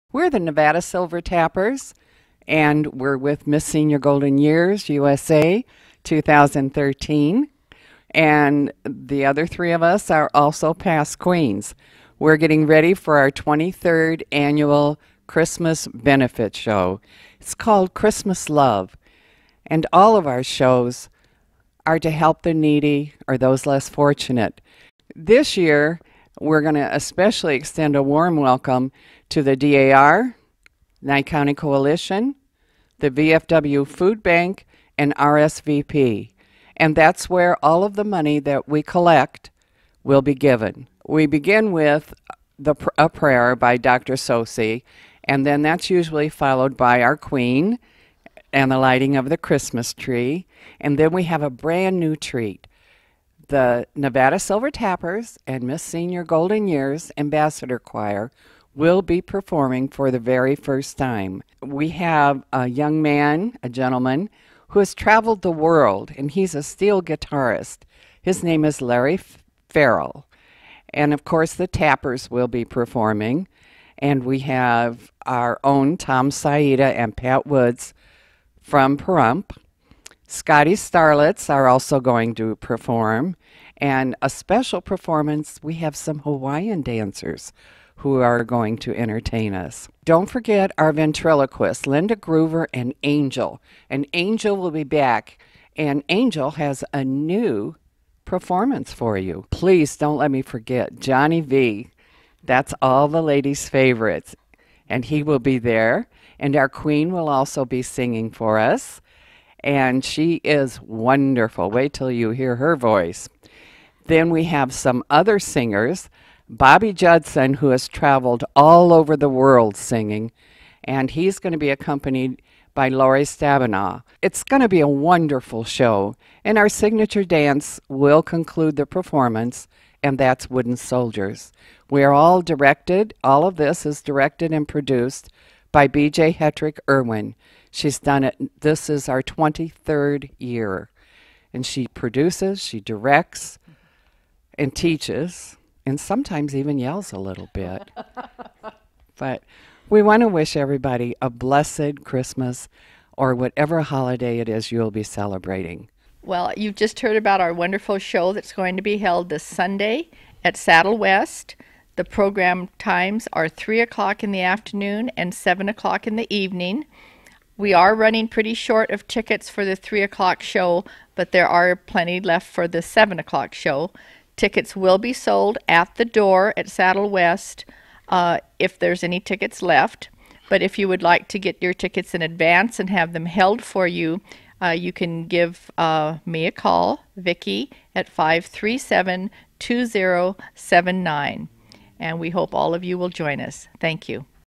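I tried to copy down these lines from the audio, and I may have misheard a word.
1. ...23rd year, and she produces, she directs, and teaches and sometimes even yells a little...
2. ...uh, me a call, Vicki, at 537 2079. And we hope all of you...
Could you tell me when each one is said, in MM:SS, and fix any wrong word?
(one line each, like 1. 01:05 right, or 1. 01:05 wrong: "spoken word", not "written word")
1. 02:19 right
2. 03:05 right.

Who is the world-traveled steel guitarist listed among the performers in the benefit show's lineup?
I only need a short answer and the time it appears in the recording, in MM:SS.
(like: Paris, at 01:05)
Larry Farrell, at 01:08.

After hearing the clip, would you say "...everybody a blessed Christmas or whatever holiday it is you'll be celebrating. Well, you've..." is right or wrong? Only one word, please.
right.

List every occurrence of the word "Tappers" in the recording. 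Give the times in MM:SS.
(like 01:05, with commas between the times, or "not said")
00:01, 00:54, 01:11.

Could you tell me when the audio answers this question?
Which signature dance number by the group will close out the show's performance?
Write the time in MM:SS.
02:10.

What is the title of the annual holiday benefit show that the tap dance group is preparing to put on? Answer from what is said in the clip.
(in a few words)
Christmas Love.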